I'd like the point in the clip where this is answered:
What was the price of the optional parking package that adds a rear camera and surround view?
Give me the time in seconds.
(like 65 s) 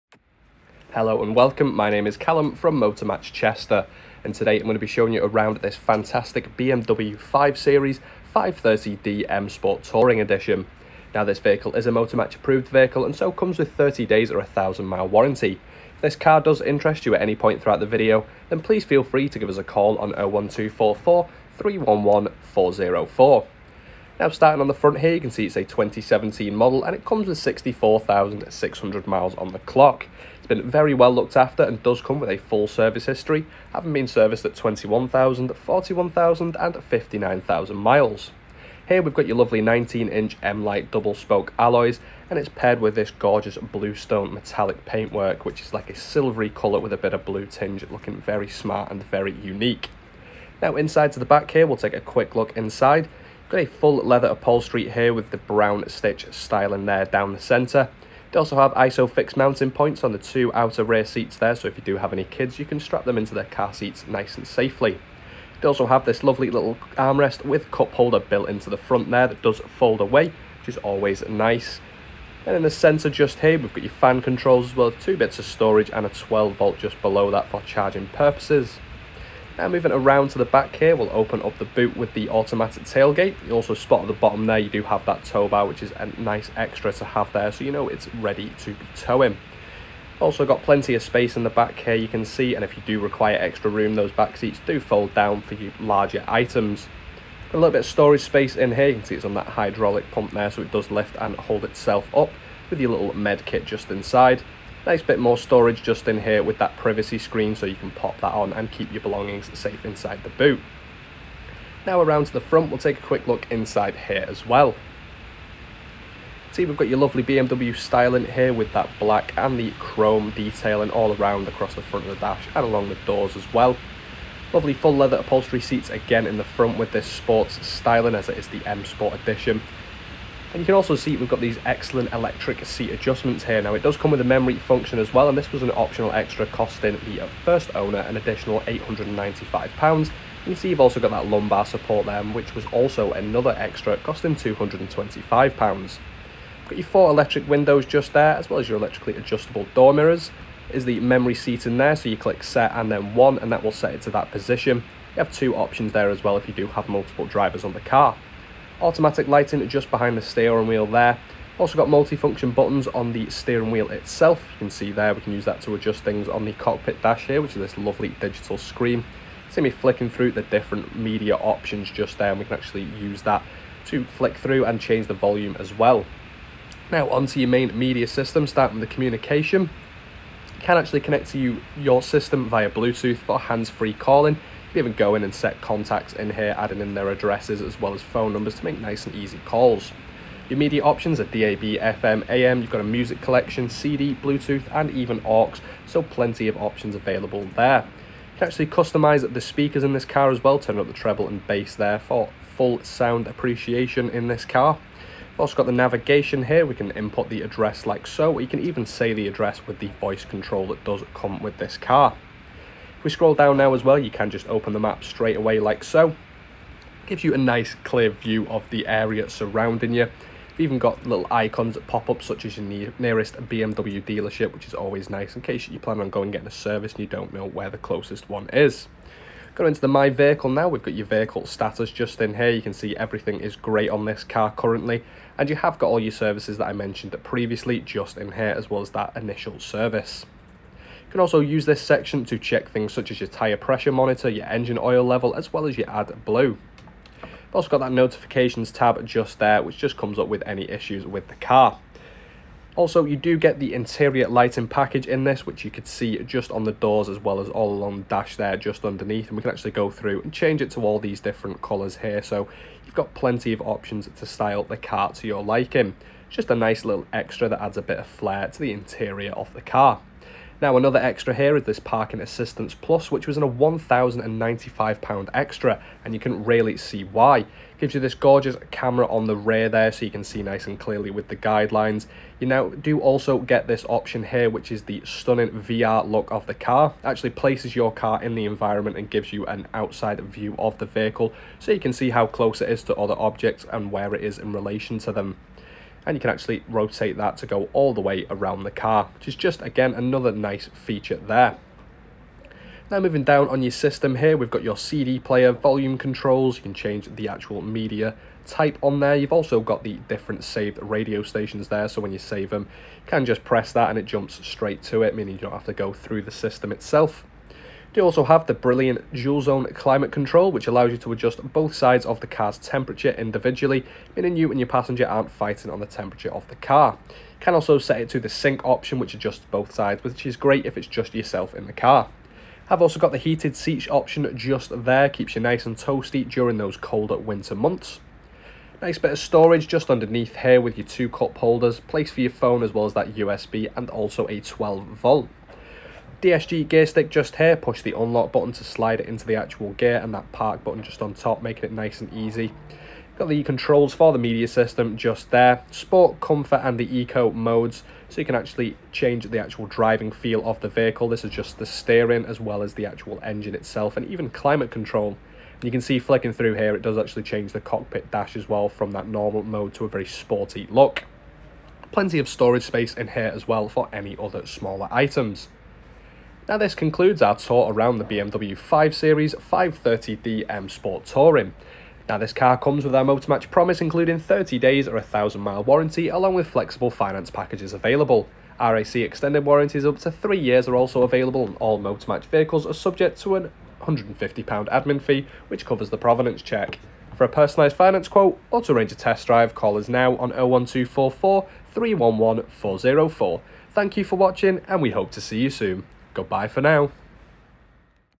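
273 s.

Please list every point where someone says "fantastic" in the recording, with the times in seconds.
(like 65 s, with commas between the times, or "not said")
5 s.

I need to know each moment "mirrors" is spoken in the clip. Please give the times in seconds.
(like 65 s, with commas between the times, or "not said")
149 s.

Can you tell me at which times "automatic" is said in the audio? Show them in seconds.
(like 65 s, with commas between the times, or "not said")
82 s, 158 s.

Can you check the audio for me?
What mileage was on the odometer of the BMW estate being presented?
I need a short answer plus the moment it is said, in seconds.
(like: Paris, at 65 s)
64,600, at 27 s.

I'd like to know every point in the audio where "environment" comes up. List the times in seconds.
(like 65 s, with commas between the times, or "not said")
288 s.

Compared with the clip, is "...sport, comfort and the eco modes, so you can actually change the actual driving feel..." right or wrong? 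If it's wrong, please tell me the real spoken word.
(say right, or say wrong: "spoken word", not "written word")
right.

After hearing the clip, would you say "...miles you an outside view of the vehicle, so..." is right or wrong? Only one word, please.
wrong.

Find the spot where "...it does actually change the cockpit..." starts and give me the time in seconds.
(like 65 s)
366 s.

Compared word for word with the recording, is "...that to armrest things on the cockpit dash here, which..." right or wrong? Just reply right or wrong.
wrong.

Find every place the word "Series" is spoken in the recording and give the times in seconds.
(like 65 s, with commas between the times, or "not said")
7 s, 378 s.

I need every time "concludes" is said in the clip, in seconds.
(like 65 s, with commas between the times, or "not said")
376 s.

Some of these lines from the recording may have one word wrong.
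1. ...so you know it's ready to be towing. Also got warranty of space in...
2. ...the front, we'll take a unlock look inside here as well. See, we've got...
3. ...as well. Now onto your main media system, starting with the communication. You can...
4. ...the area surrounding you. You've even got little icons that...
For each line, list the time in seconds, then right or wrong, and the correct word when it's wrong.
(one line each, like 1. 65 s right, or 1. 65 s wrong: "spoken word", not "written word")
1. 87 s wrong: "plenty", not "warranty"
2. 112 s wrong: "quick", not "unlock"
3. 175 s right
4. 218 s right.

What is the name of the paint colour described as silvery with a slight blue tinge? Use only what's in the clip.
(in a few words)
Bluestone metallic.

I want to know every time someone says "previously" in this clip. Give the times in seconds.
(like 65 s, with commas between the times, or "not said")
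237 s.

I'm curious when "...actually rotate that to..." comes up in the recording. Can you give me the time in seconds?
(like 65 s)
296 s.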